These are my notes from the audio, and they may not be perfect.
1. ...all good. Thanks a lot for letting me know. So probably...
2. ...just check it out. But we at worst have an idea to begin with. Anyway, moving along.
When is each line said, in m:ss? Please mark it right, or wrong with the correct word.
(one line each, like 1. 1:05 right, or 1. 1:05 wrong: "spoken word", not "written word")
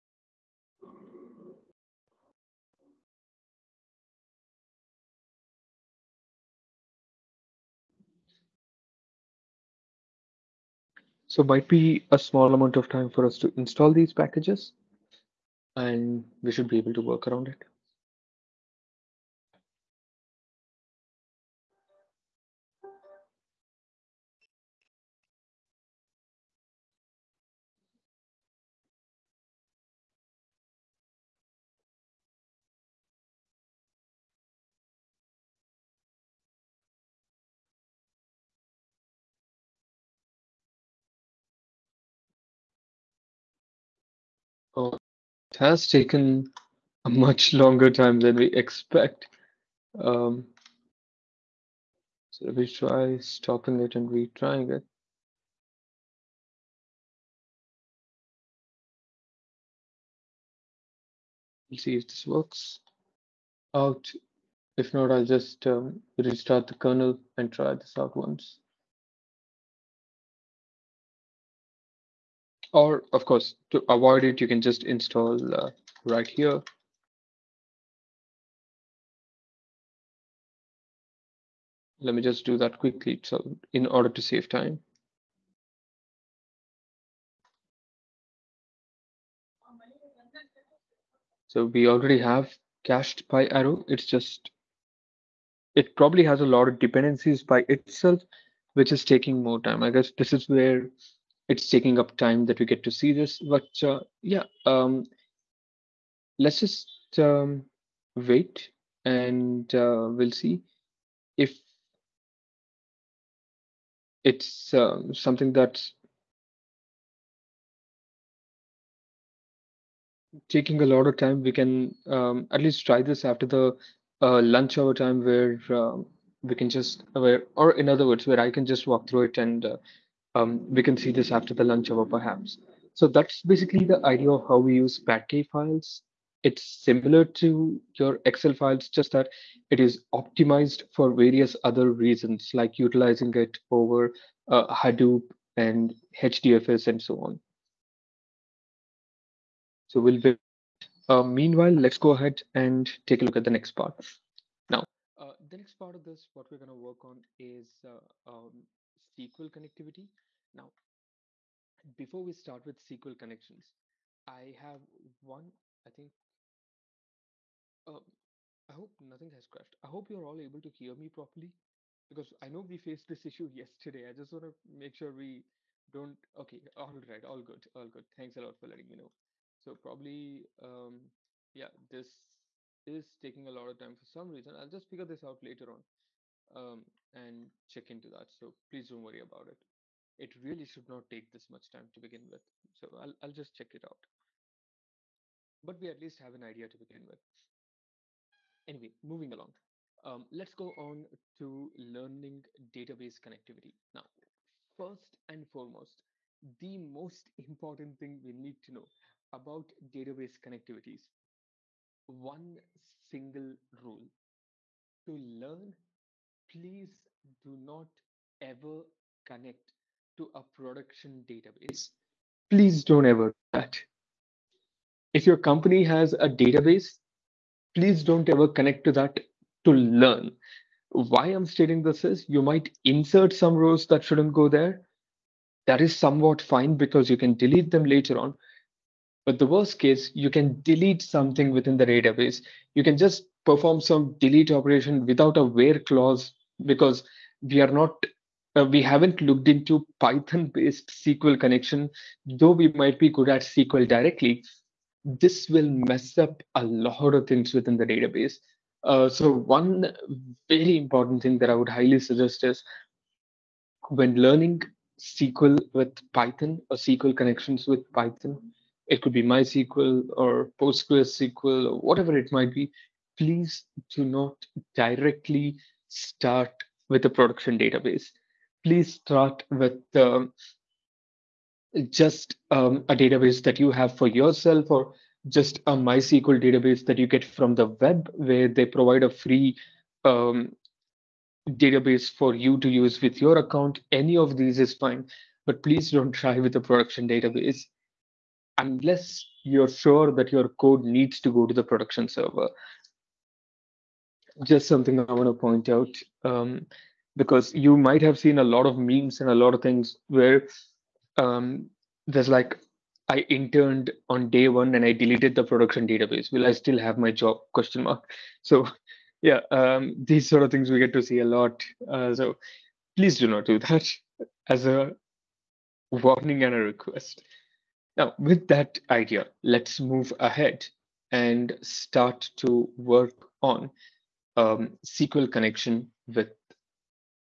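1. 2:57 right
2. 3:13 wrong: "least", not "worst".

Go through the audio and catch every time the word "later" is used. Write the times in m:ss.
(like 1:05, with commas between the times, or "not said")
3:05, 3:57.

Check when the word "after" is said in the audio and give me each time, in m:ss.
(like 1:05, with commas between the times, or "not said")
2:03, 2:11.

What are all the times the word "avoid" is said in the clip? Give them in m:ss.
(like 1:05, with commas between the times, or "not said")
1:13.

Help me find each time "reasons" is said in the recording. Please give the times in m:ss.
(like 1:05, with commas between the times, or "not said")
2:21, 3:04.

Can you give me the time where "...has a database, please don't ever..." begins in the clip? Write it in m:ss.
3:45.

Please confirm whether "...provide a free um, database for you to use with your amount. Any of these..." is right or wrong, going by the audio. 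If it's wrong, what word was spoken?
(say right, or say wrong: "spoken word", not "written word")
wrong: "account", not "amount".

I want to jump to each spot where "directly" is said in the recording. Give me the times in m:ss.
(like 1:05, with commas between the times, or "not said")
4:13, 4:34.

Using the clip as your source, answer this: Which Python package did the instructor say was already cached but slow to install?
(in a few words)
PyArrow.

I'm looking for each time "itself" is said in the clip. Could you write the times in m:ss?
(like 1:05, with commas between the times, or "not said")
1:37.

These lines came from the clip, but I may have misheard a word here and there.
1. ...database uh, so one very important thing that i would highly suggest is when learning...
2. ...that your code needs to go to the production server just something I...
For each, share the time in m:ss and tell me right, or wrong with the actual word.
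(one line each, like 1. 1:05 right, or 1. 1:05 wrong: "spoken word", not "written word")
1. 4:17 right
2. 5:00 right.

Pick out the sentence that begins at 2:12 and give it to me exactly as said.
So that's basically the idea of how we use Parquet files.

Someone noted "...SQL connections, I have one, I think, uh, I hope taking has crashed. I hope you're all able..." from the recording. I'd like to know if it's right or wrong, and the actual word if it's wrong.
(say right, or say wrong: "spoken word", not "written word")
wrong: "nothing", not "taking".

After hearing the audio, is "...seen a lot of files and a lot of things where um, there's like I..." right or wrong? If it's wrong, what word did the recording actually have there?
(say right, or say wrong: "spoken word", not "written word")
wrong: "memes", not "files".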